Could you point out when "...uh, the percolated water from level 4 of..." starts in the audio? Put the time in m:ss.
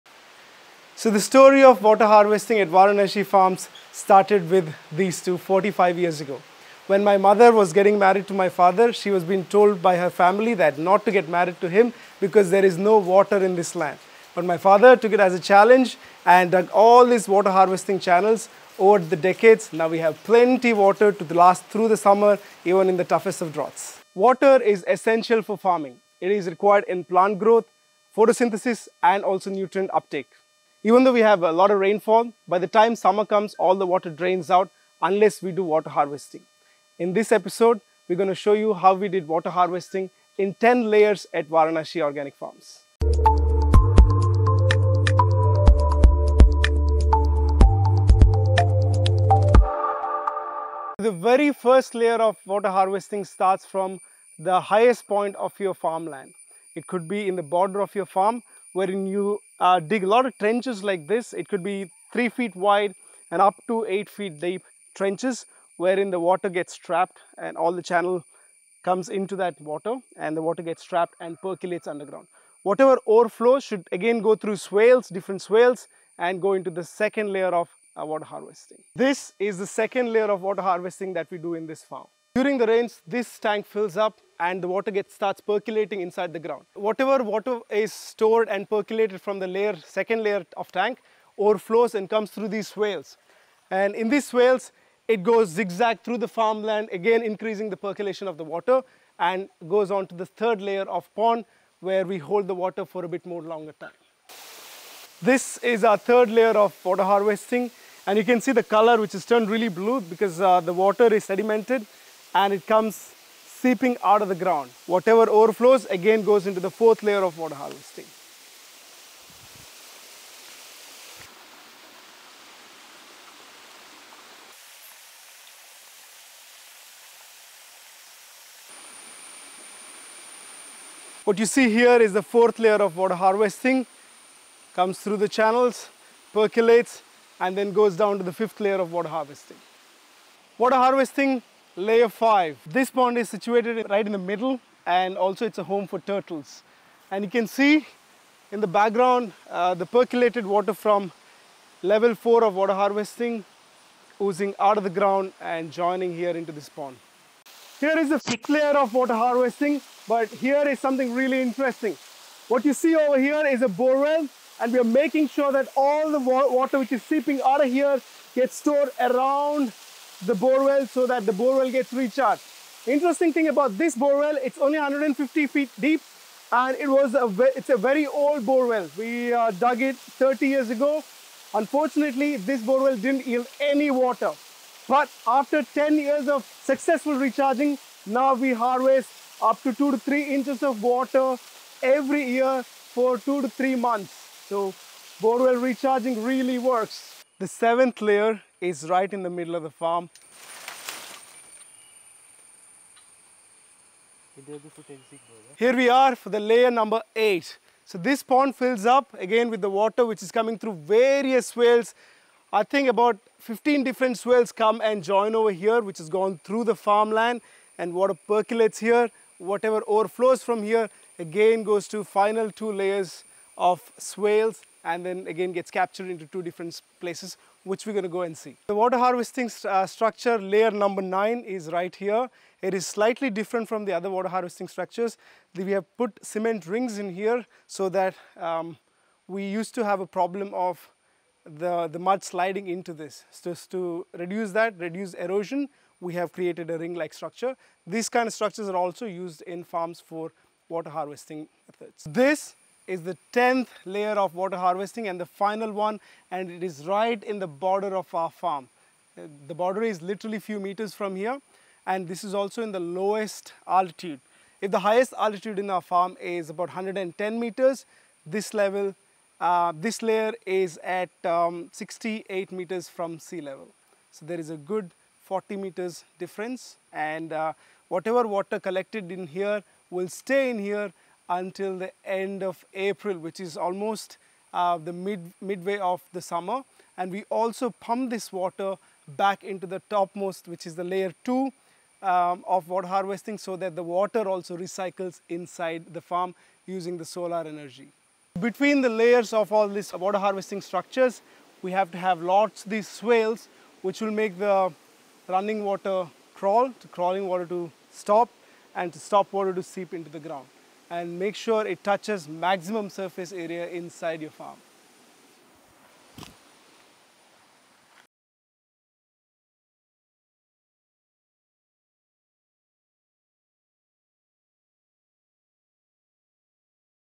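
2:29.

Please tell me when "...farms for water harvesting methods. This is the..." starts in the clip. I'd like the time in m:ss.
4:09.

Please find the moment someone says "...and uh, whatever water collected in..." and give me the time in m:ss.
4:36.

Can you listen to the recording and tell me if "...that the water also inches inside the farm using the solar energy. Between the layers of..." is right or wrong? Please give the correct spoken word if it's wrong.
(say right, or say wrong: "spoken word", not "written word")
wrong: "recycles", not "inches".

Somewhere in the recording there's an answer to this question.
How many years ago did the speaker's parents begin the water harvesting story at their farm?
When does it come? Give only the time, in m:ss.
0:05.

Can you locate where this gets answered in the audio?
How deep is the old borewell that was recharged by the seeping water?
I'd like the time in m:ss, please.
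2:54.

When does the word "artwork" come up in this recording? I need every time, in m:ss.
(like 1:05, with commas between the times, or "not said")
not said.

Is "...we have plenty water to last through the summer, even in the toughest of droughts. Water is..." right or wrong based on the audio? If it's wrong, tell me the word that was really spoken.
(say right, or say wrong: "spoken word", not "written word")
right.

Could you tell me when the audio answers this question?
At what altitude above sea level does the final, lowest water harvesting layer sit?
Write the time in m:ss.
4:31.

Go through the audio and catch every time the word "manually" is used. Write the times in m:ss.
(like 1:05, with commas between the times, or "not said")
not said.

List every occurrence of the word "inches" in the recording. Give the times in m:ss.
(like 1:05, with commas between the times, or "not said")
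3:10.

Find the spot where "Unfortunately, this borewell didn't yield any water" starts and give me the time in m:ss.
3:01.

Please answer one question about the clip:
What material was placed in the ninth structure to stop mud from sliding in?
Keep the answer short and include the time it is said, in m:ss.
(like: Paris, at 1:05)
Cement rings, at 3:56.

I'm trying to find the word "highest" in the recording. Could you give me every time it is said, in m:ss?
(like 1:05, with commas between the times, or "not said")
0:54, 4:24.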